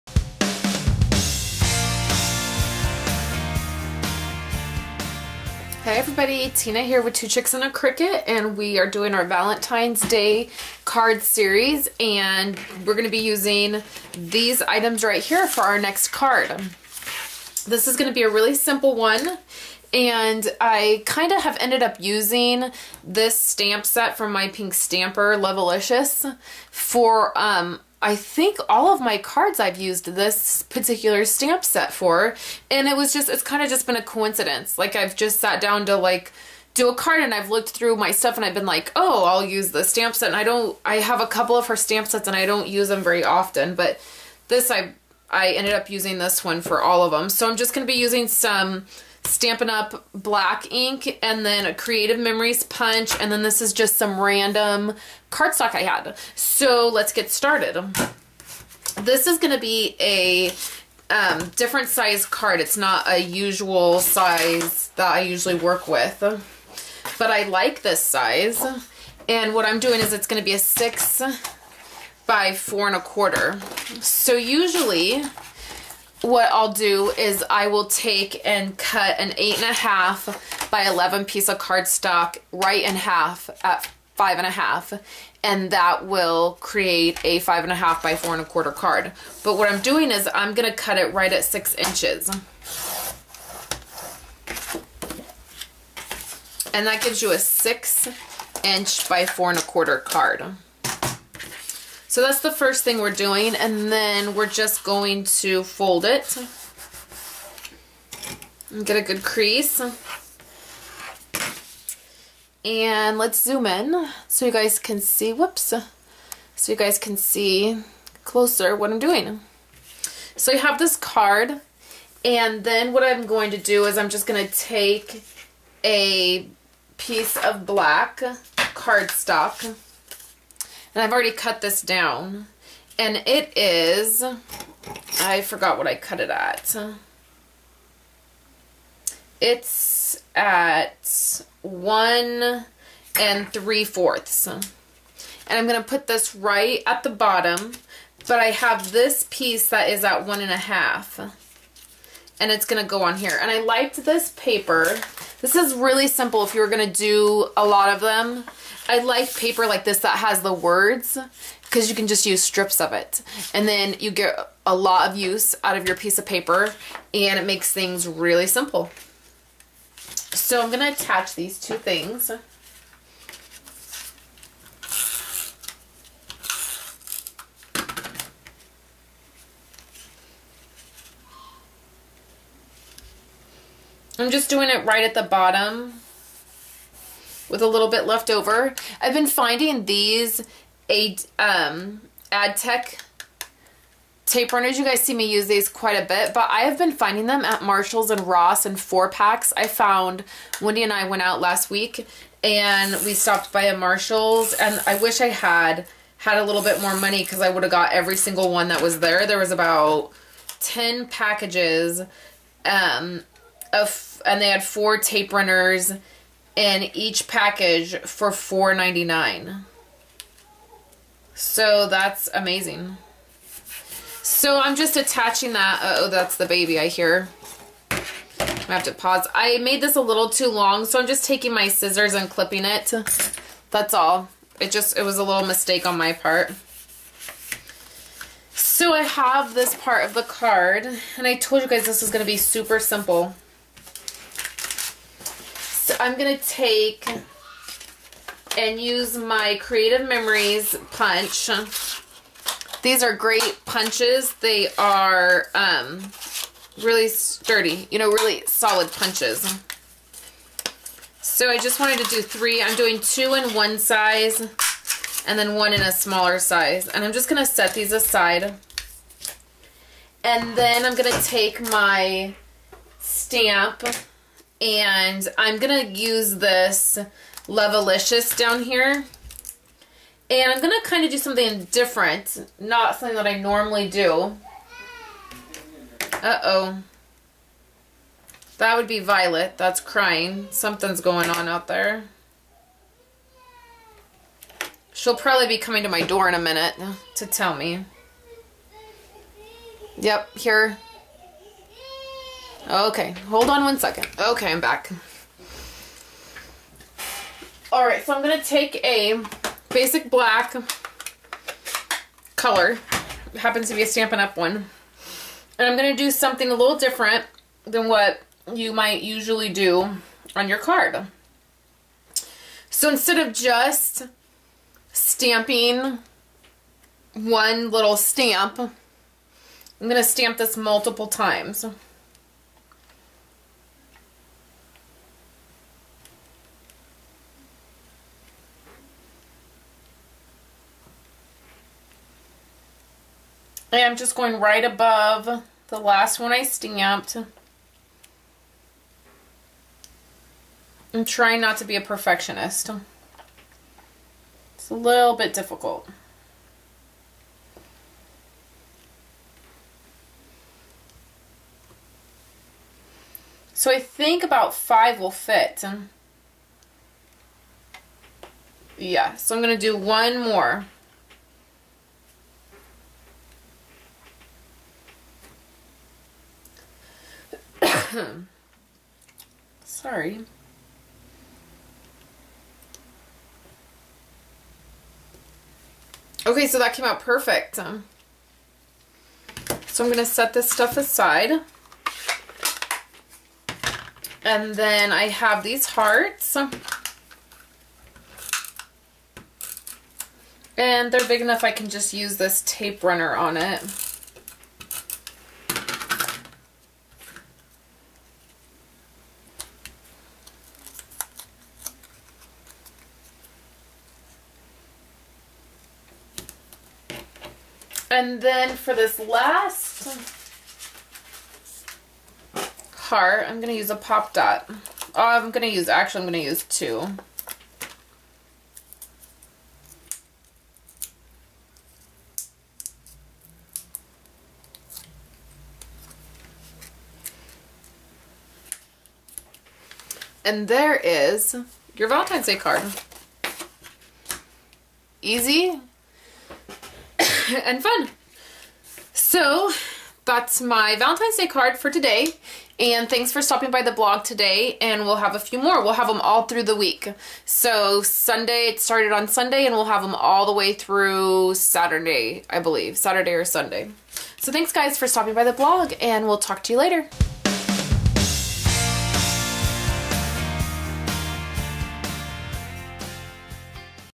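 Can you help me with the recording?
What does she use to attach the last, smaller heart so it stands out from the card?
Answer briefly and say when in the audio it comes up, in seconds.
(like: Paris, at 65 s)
pop dot, at 423 s.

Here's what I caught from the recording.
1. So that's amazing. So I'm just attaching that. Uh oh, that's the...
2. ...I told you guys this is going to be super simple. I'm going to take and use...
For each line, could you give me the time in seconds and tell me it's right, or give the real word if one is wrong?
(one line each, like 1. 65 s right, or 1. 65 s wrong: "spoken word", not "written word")
1. 221 s right
2. 241 s right.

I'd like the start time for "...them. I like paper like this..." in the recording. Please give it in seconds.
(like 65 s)
157 s.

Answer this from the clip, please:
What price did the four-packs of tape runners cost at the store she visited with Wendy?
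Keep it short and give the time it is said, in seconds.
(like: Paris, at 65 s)
$4.99, at 218 s.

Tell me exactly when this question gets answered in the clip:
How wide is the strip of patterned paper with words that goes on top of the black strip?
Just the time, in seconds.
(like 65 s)
150 s.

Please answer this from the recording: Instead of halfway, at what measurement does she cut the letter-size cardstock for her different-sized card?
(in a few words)
6 inches.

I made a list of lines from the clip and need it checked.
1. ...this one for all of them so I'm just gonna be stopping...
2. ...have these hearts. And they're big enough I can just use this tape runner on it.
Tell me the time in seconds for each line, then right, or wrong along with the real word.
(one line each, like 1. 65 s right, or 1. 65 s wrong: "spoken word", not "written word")
1. 46 s wrong: "using", not "stopping"
2. 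395 s right.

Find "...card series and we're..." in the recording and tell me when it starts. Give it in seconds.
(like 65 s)
10 s.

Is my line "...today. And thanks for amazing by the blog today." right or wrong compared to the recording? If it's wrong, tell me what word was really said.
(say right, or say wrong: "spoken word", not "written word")
wrong: "stopping", not "amazing".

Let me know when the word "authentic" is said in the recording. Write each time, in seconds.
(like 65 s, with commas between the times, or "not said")
not said.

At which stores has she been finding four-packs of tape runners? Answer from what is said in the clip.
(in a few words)
Marshalls and Ross.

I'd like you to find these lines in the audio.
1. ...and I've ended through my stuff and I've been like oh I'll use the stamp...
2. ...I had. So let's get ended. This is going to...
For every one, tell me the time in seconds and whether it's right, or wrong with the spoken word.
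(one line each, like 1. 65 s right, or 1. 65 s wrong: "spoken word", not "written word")
1. 37 s wrong: "looked", not "ended"
2. 55 s wrong: "started", not "ended".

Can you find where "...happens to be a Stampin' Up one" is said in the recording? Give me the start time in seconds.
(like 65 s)
313 s.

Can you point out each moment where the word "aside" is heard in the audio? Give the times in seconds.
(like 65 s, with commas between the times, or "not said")
267 s, 390 s.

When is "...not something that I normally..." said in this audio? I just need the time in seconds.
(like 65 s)
282 s.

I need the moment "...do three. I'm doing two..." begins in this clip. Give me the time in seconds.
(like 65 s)
262 s.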